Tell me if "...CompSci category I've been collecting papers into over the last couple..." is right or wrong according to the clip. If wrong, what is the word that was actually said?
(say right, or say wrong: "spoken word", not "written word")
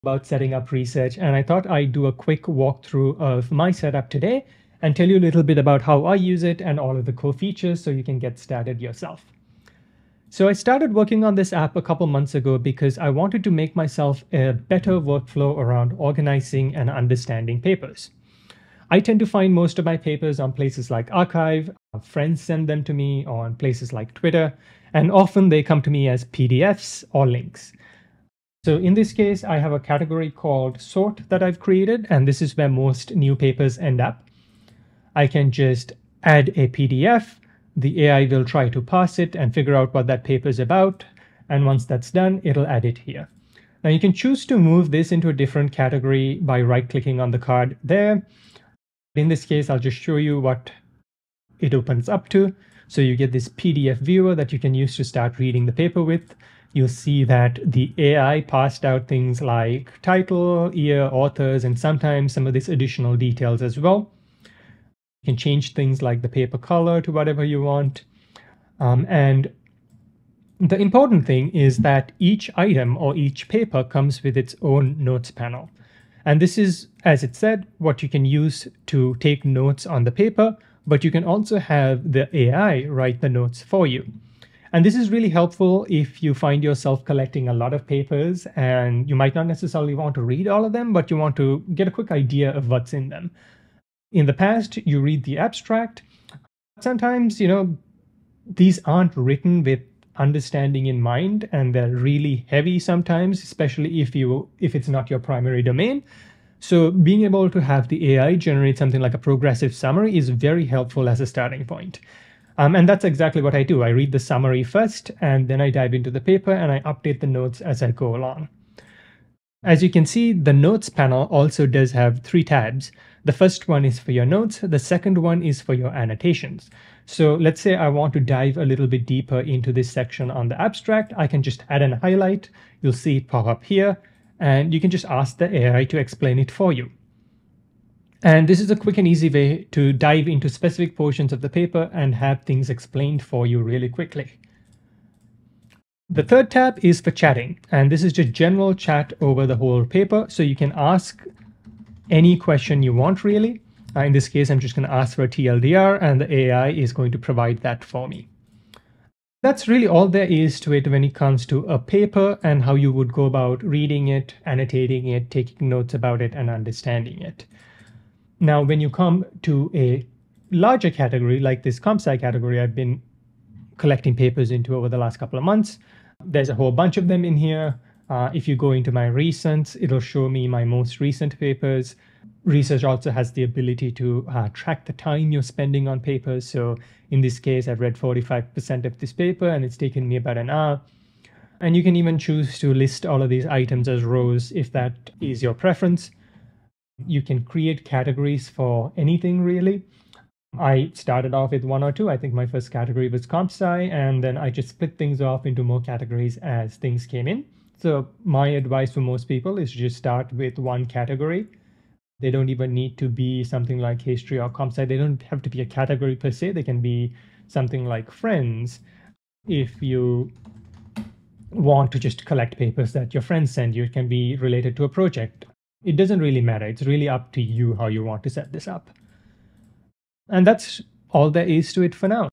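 right.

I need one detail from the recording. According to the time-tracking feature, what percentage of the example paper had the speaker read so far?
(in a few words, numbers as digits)
45%.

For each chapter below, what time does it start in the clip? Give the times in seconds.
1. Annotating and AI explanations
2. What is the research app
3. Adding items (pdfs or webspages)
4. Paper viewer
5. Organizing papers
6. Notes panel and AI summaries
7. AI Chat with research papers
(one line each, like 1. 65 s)
1. 120 s
2. 13 s
3. 29 s
4. 52 s
5. 169 s
6. 70 s
7. 147 s.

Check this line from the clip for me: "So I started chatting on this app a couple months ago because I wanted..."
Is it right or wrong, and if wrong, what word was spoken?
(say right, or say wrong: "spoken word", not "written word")
wrong: "working", not "chatting".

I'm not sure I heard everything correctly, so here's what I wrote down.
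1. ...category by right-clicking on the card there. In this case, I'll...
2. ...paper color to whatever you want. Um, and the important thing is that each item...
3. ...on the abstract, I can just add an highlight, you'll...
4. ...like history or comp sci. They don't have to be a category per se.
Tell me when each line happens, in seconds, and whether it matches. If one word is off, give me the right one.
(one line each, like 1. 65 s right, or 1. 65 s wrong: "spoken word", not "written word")
1. 45 s right
2. 66 s right
3. 130 s right
4. 213 s right.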